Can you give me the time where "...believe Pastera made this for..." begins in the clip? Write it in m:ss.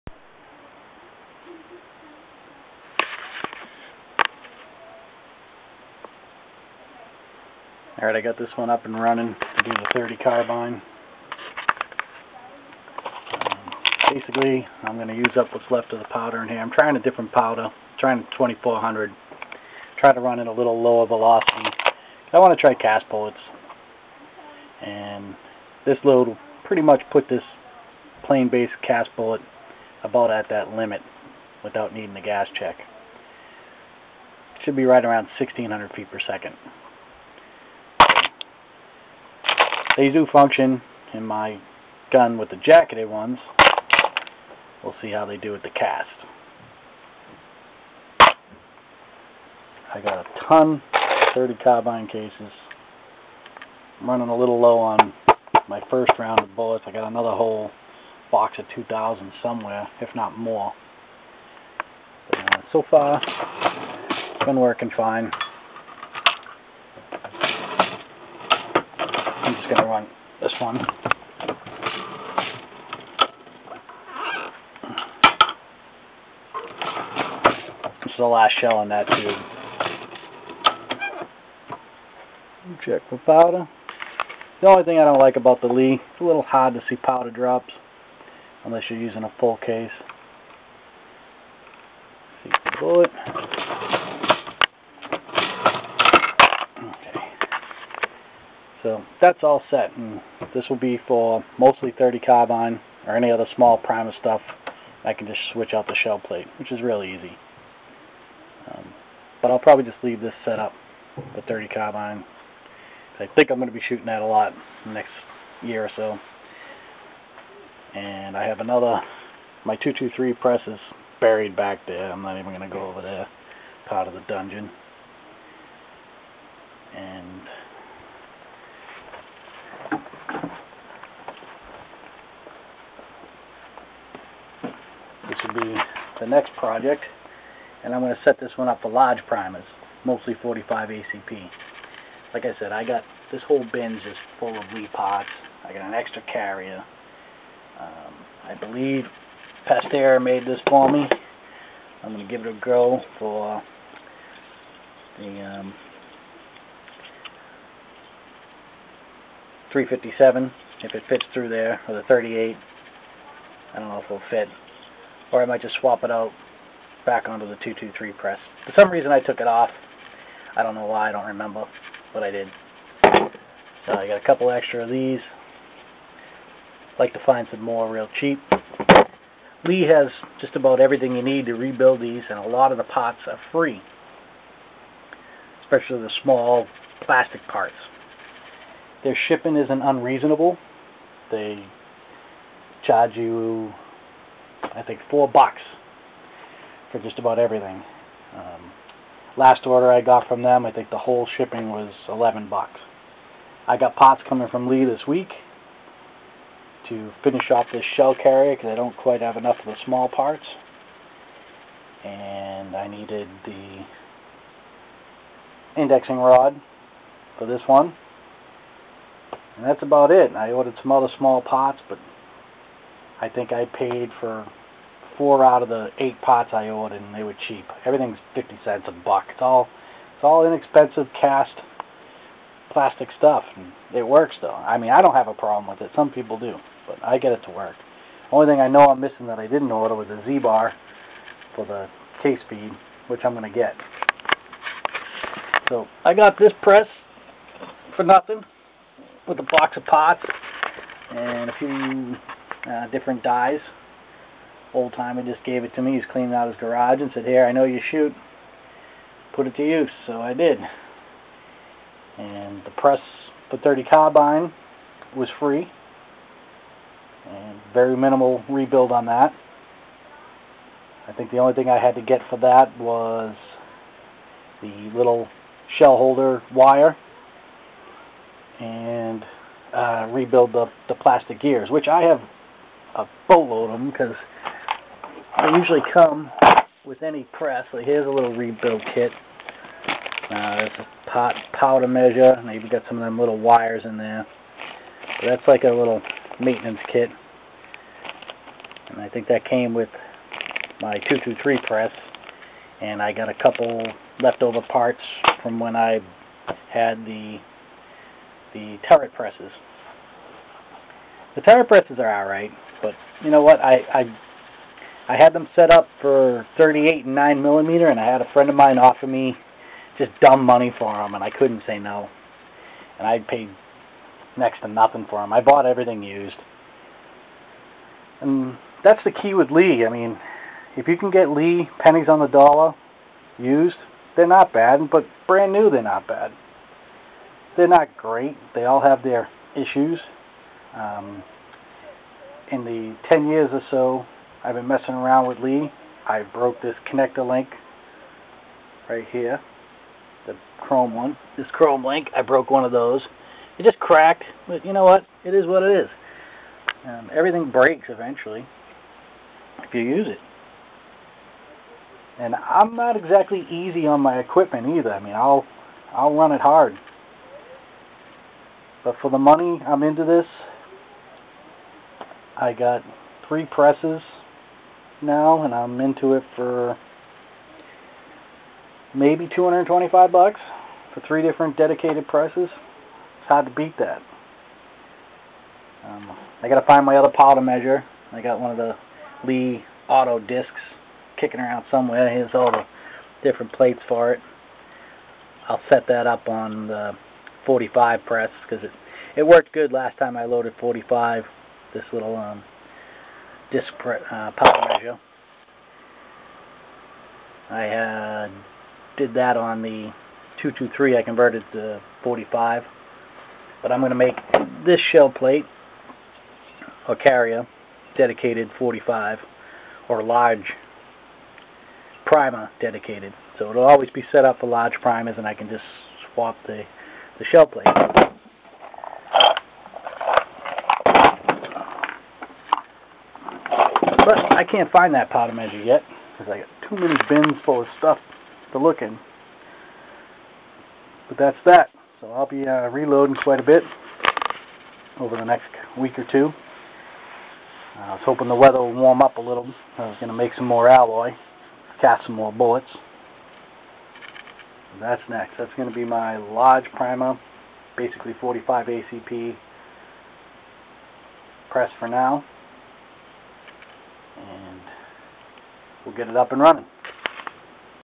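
2:28.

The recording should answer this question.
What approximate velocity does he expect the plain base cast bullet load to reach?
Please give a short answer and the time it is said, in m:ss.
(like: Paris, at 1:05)
1600 feet per second, at 0:35.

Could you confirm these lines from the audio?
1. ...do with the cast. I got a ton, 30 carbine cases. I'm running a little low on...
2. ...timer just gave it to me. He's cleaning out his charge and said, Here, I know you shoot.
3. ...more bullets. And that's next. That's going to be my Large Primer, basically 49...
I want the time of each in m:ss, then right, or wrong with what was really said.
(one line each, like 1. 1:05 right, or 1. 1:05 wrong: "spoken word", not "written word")
1. 0:45 right
2. 4:14 wrong: "garage", not "charge"
3. 7:32 wrong: "45", not "49".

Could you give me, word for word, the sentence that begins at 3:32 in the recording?
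And I needed the indexing rod for this one.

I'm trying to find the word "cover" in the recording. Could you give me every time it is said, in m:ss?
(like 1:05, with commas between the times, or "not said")
not said.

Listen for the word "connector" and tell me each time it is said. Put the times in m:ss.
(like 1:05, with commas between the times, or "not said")
5:46.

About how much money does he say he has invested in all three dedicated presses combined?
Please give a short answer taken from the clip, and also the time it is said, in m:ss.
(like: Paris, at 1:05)
225 bucks, at 6:19.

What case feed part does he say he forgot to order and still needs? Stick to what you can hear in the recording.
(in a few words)
Z-bar.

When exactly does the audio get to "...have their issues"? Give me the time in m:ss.
5:38.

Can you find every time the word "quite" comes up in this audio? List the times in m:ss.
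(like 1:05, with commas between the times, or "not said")
3:28, 7:23.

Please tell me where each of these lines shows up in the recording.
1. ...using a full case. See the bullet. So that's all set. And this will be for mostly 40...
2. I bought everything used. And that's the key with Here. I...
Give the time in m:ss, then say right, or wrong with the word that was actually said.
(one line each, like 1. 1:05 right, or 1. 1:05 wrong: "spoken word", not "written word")
1. 1:28 wrong: "30", not "40"
2. 5:25 wrong: "Lee", not "Here".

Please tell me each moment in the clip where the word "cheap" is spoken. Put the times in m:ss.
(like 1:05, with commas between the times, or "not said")
2:58, 3:47.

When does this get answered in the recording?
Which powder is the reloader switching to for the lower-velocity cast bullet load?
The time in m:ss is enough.
0:18.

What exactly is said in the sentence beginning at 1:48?
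Um, but I'll probably just leave this set up the 30 carbine.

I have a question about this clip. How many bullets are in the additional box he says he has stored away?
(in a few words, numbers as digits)
2,000.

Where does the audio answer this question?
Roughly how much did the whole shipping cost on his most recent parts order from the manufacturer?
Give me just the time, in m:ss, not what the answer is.
3:22.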